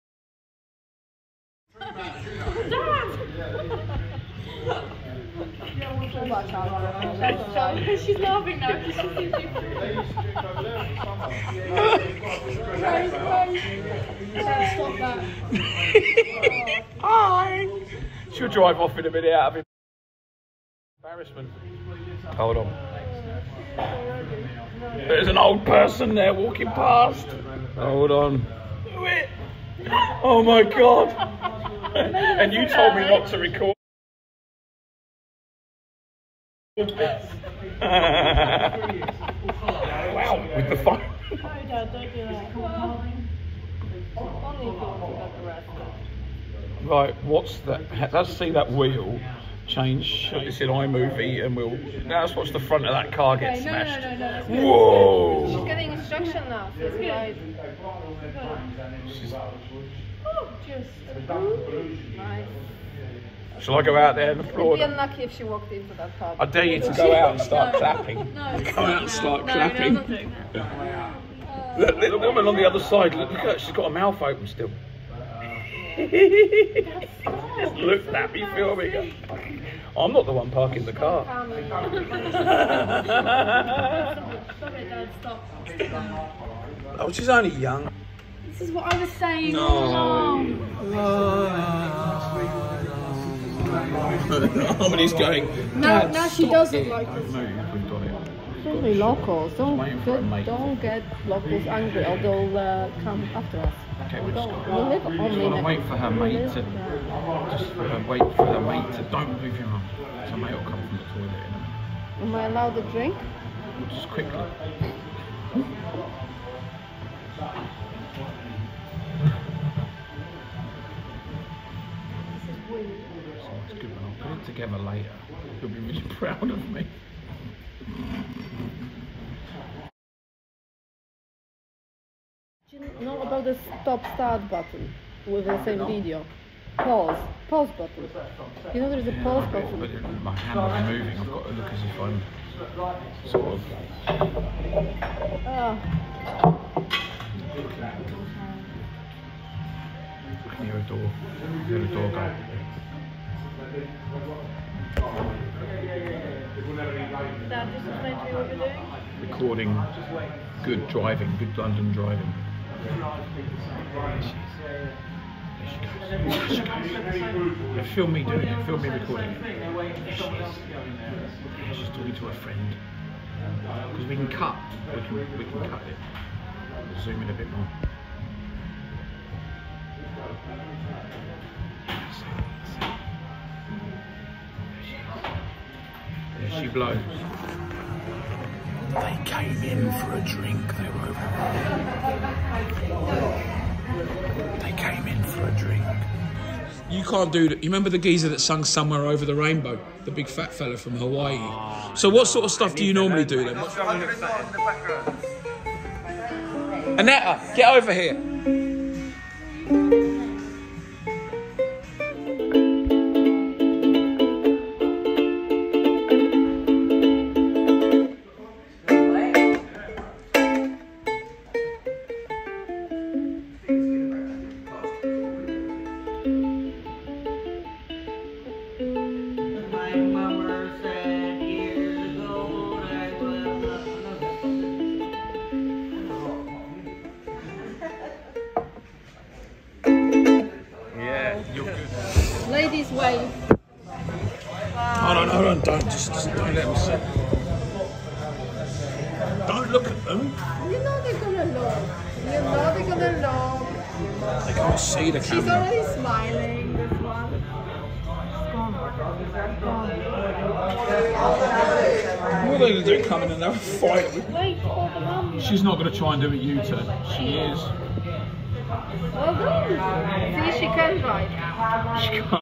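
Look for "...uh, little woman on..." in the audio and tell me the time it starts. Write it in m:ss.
1:11.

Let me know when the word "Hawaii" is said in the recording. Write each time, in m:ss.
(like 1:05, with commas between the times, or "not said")
3:20.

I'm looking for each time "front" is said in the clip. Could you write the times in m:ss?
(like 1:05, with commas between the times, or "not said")
0:52.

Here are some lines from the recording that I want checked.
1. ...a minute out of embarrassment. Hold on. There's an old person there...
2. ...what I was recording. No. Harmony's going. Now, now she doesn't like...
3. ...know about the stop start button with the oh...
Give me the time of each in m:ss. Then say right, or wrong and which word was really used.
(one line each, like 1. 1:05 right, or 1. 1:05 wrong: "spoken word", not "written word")
1. 0:19 right
2. 1:28 wrong: "saying", not "recording"
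3. 2:13 right.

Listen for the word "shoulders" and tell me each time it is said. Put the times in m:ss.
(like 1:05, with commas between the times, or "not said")
not said.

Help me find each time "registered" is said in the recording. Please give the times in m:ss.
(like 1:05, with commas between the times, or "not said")
not said.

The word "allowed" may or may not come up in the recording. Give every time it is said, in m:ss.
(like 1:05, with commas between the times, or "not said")
1:52.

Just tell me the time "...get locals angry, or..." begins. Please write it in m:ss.
1:40.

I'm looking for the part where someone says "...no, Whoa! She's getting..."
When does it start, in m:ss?
0:54.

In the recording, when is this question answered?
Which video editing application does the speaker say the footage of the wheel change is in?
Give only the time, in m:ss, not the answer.
0:50.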